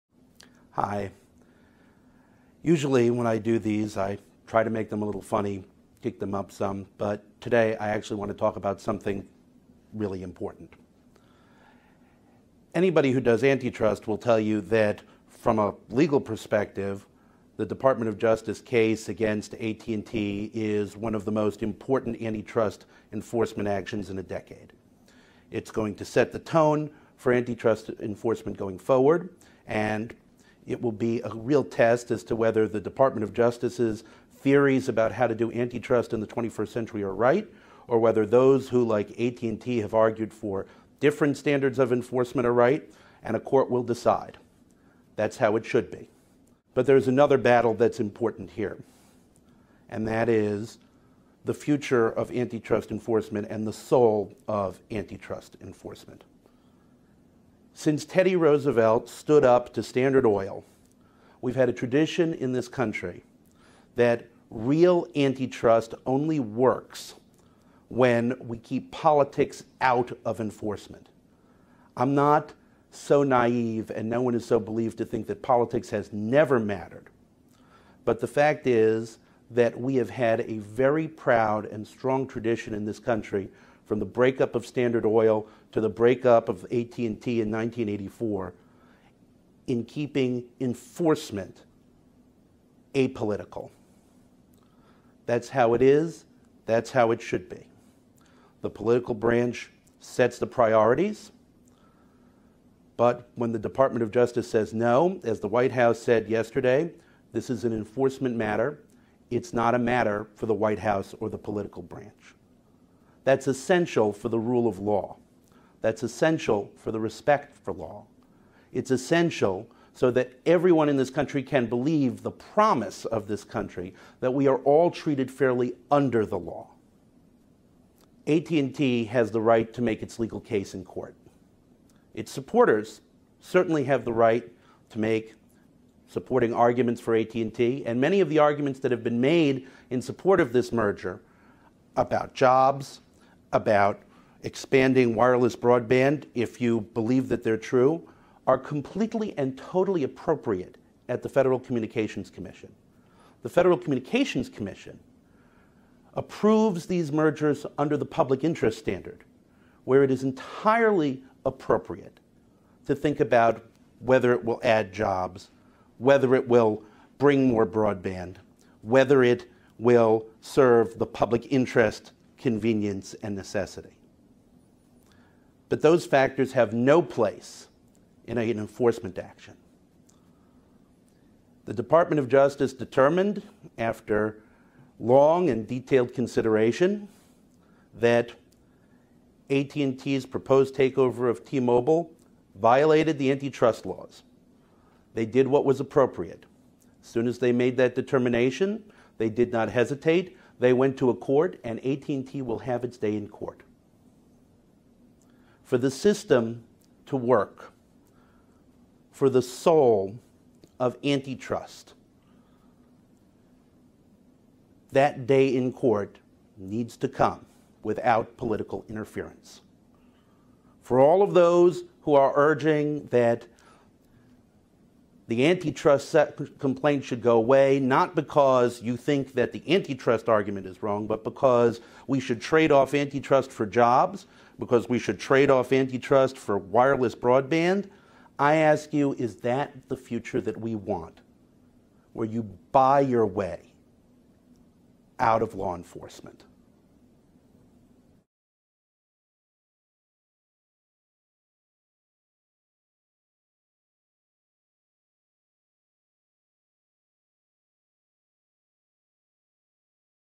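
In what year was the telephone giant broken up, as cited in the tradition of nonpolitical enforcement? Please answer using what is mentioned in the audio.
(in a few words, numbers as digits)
1984.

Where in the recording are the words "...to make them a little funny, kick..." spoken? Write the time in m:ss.
0:04.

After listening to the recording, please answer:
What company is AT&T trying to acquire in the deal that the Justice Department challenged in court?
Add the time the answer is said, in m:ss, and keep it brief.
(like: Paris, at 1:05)
T-Mobile, at 3:11.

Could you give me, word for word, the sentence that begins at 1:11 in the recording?
I'm not so naive, and no one is so believed to think that politics has never mattered.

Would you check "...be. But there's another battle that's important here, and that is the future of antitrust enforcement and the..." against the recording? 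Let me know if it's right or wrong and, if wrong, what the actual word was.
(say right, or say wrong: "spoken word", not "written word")
right.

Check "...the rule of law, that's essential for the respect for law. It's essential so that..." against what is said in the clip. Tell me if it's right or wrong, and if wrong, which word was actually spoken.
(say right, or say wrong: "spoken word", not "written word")
right.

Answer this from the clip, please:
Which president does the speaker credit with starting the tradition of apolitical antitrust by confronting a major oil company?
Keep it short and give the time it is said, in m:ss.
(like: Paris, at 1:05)
Teddy Roosevelt, at 0:58.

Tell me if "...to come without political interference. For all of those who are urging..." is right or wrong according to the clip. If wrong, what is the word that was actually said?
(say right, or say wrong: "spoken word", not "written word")
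right.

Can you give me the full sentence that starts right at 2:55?
But those factors have no place in an enforcement action.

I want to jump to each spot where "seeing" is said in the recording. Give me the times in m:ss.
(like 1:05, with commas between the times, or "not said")
not said.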